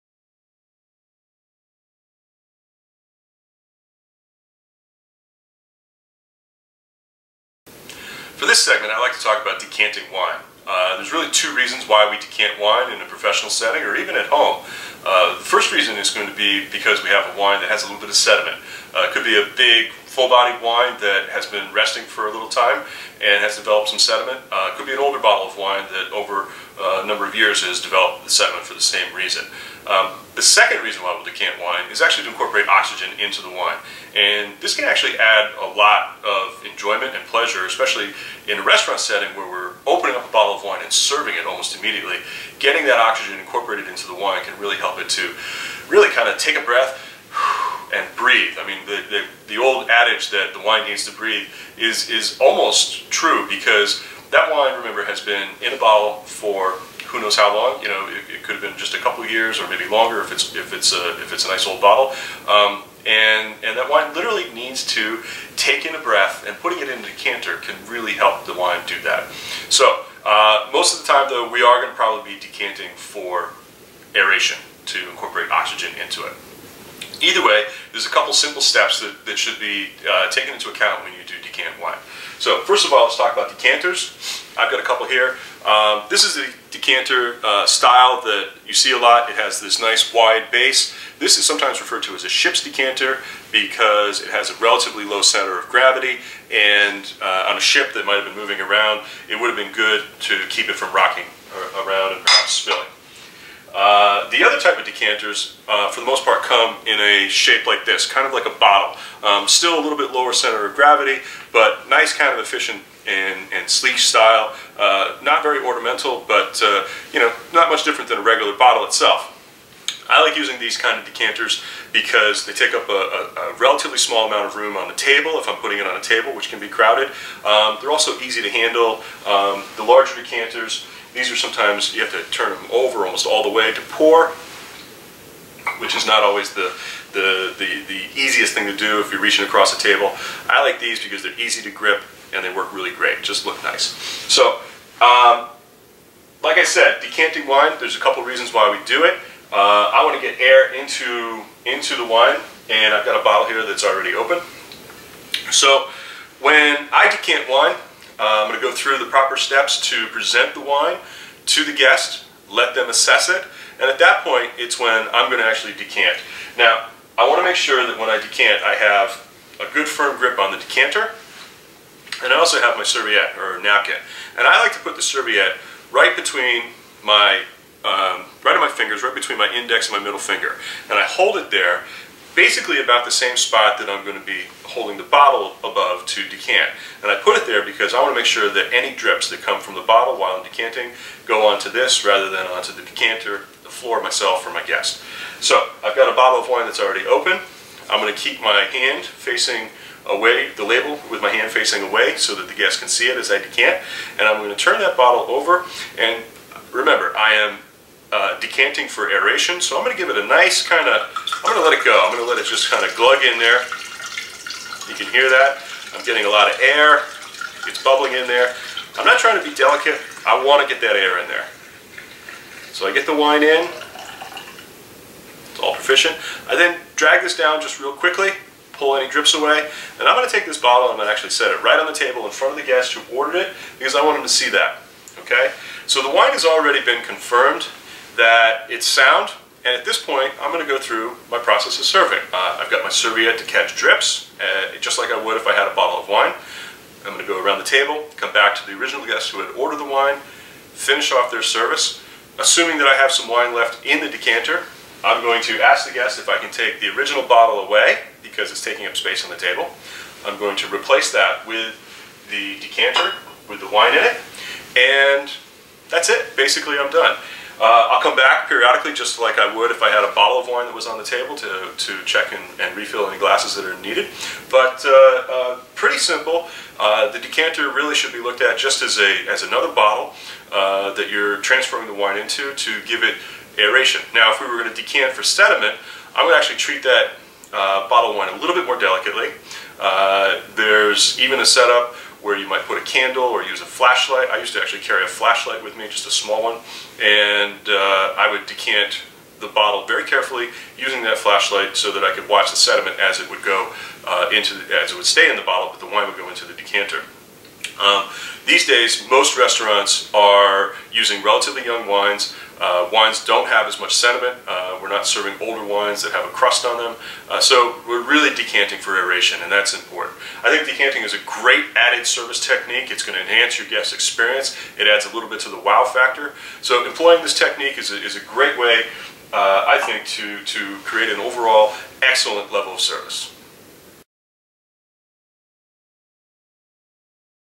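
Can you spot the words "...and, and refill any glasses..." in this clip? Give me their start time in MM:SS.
04:32.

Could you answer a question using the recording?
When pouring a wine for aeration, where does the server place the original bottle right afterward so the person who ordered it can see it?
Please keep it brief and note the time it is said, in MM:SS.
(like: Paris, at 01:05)
on the table in front of the guest, at 03:51.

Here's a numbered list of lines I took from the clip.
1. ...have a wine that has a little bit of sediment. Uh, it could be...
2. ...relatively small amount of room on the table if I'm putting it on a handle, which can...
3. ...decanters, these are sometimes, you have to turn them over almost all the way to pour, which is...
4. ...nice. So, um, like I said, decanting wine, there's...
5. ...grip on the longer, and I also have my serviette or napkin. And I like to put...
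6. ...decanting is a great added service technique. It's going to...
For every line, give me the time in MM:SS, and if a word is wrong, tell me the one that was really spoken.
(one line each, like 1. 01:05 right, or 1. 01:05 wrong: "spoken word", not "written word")
1. 00:17 right
2. 02:03 wrong: "table", not "handle"
3. 02:10 right
4. 02:23 right
5. 02:50 wrong: "decanter", not "longer"
6. 05:20 right.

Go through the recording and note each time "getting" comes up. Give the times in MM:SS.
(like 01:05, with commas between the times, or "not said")
00:42, 03:36.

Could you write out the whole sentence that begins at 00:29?
Um, the second reason why we'll decant wine is actually to incorporate oxygen into the wine.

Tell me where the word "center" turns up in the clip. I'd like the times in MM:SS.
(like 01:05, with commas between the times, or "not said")
01:35, 01:50.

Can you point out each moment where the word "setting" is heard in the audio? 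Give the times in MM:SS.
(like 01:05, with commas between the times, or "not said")
00:13, 00:38.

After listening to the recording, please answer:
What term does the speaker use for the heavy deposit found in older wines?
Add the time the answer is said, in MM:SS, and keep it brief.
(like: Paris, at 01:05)
crust, at 05:16.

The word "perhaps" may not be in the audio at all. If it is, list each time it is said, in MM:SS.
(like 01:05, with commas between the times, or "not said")
01:42.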